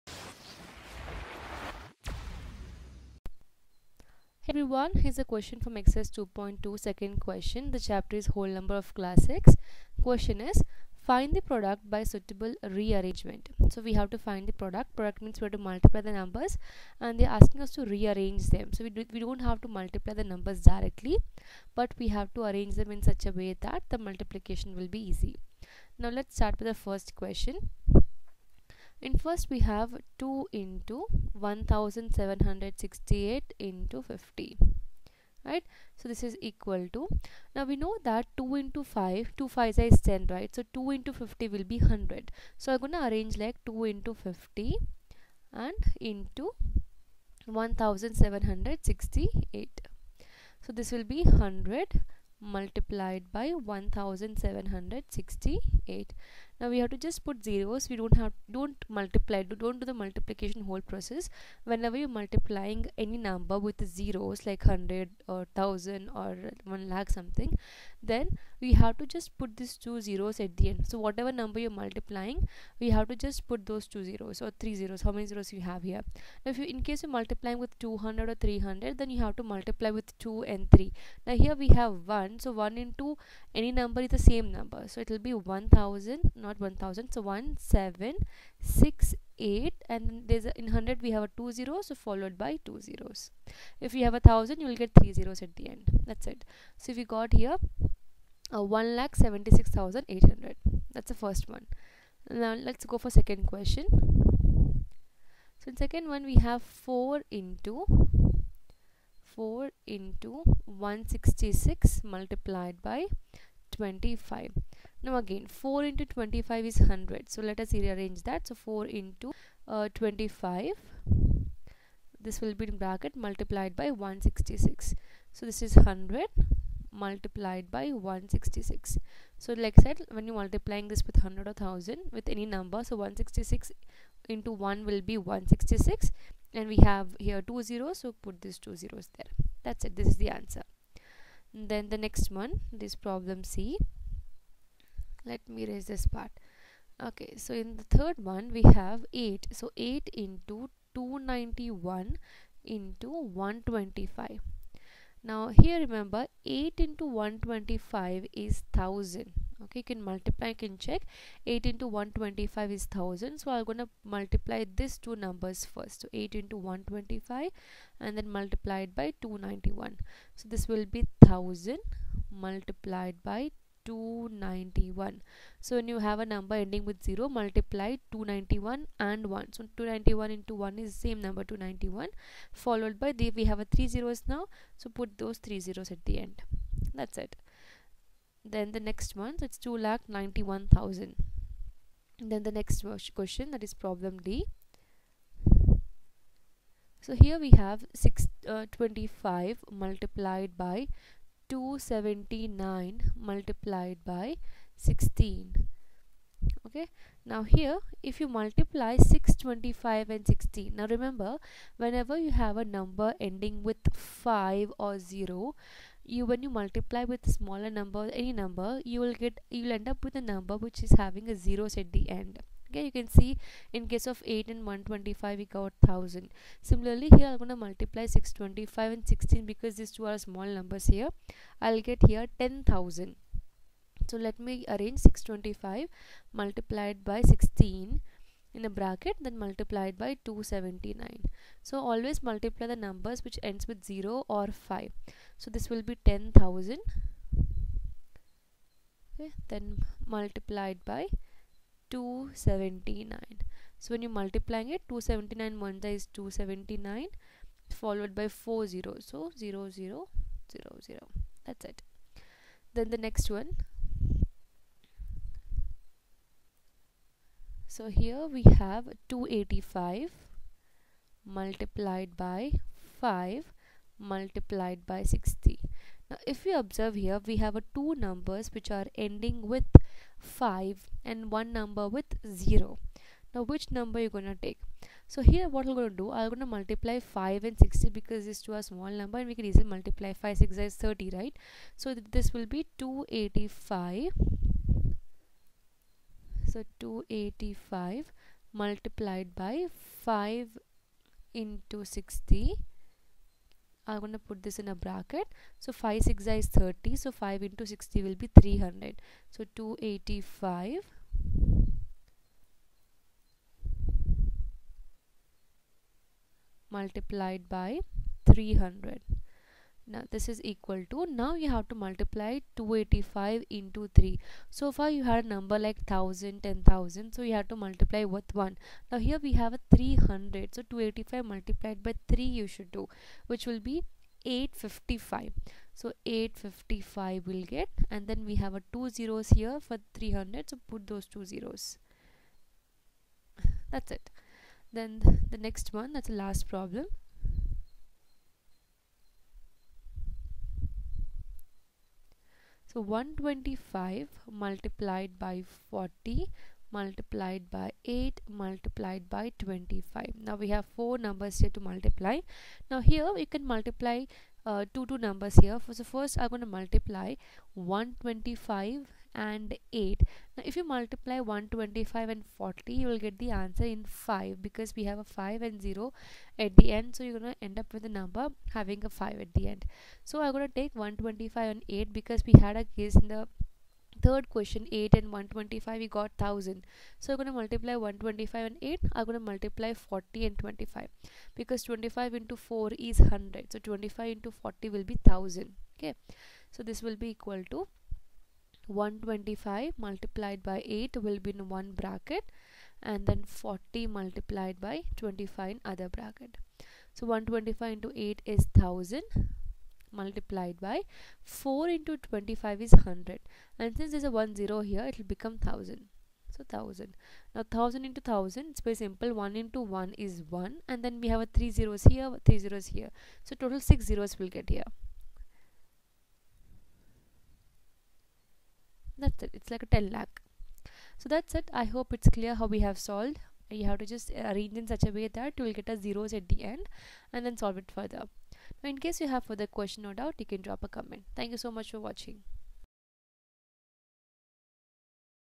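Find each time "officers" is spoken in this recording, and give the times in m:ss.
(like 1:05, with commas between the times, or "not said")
not said.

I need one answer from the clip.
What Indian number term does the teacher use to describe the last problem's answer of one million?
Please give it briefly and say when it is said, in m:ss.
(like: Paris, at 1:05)
10 lakh, at 7:09.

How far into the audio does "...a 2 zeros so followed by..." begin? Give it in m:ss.
1:31.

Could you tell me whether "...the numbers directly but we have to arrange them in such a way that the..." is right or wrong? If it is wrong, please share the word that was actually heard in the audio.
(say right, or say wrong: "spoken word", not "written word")
right.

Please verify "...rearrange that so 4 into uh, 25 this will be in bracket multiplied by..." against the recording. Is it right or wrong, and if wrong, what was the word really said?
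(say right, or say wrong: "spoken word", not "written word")
right.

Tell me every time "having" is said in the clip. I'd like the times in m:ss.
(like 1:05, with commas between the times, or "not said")
3:40, 6:18.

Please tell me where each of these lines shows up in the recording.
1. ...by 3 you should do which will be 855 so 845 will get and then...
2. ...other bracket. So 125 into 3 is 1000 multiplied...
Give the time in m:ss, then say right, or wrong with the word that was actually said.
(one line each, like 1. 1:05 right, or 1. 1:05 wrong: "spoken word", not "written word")
1. 5:31 wrong: "855", not "845"
2. 6:45 wrong: "8", not "3".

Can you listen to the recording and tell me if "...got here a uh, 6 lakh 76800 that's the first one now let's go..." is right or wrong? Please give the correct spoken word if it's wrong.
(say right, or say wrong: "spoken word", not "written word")
wrong: "1", not "6".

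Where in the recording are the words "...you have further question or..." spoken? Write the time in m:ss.
7:19.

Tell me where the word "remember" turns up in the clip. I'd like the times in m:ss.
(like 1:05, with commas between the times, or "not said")
2:35, 3:30.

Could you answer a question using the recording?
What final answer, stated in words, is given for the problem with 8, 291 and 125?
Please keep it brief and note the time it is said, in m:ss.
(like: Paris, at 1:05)
2 lakh 91,000, at 3:09.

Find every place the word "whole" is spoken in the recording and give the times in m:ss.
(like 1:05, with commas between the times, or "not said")
0:08, 1:00.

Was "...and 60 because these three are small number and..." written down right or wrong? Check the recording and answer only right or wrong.
wrong.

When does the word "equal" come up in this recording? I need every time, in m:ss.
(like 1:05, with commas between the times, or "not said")
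5:20, 6:37.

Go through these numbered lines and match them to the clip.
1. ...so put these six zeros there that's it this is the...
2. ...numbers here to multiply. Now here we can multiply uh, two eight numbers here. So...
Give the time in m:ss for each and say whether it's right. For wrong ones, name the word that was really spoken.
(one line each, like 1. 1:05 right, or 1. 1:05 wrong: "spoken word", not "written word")
1. 2:17 wrong: "two", not "six"
2. 6:00 wrong: "two", not "eight".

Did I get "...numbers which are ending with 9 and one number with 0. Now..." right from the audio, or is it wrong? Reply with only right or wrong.
wrong.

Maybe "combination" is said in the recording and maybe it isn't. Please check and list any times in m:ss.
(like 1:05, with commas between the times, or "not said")
not said.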